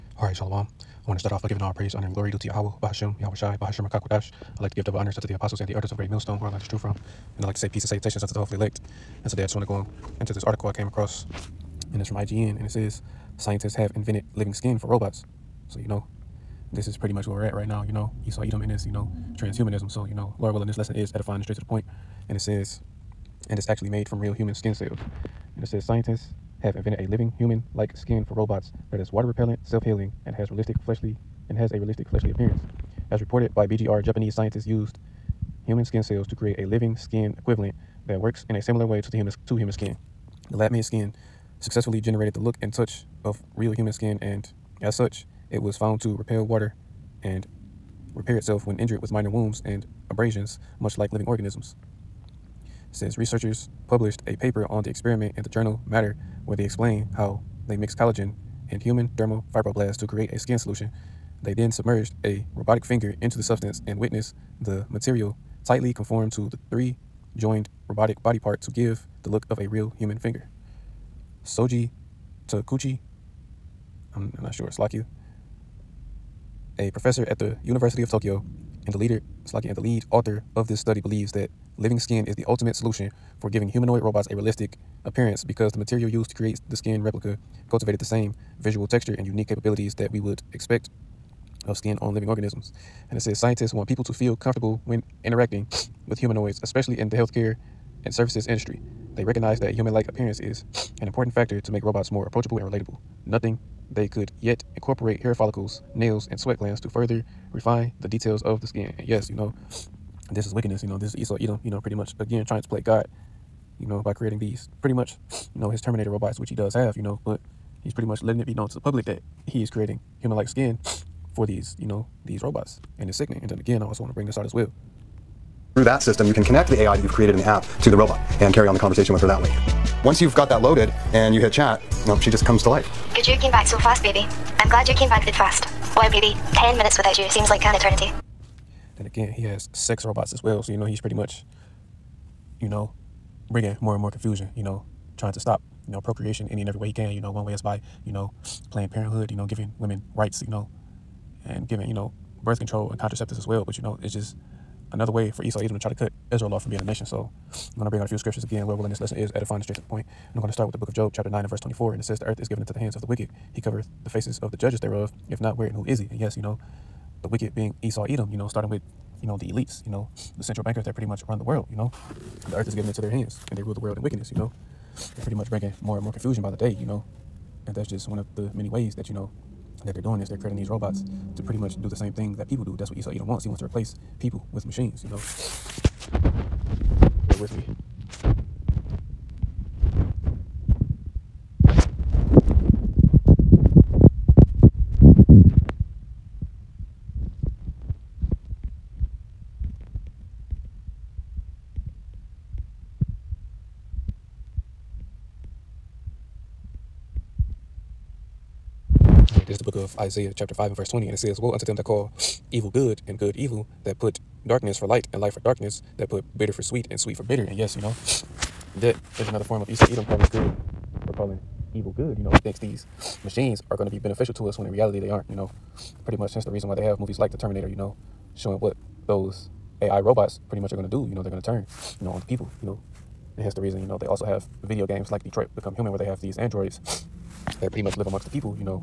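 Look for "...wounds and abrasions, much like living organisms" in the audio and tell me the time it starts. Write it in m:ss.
0:49.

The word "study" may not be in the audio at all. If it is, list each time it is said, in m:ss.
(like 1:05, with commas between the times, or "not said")
1:20.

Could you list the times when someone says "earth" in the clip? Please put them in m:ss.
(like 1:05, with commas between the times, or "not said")
2:42, 2:52.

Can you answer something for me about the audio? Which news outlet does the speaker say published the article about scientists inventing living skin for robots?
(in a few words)
IGN.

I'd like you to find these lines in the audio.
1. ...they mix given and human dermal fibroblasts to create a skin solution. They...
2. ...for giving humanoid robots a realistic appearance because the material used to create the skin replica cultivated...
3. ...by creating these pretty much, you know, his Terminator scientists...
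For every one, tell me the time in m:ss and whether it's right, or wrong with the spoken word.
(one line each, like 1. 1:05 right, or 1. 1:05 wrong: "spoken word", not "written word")
1. 0:57 wrong: "collagen", not "given"
2. 1:23 right
3. 1:54 wrong: "robots", not "scientists".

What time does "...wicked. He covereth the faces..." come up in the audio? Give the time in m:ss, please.
2:43.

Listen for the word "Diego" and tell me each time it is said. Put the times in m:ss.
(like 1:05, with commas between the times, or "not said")
not said.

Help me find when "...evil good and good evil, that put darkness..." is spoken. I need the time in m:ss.
3:32.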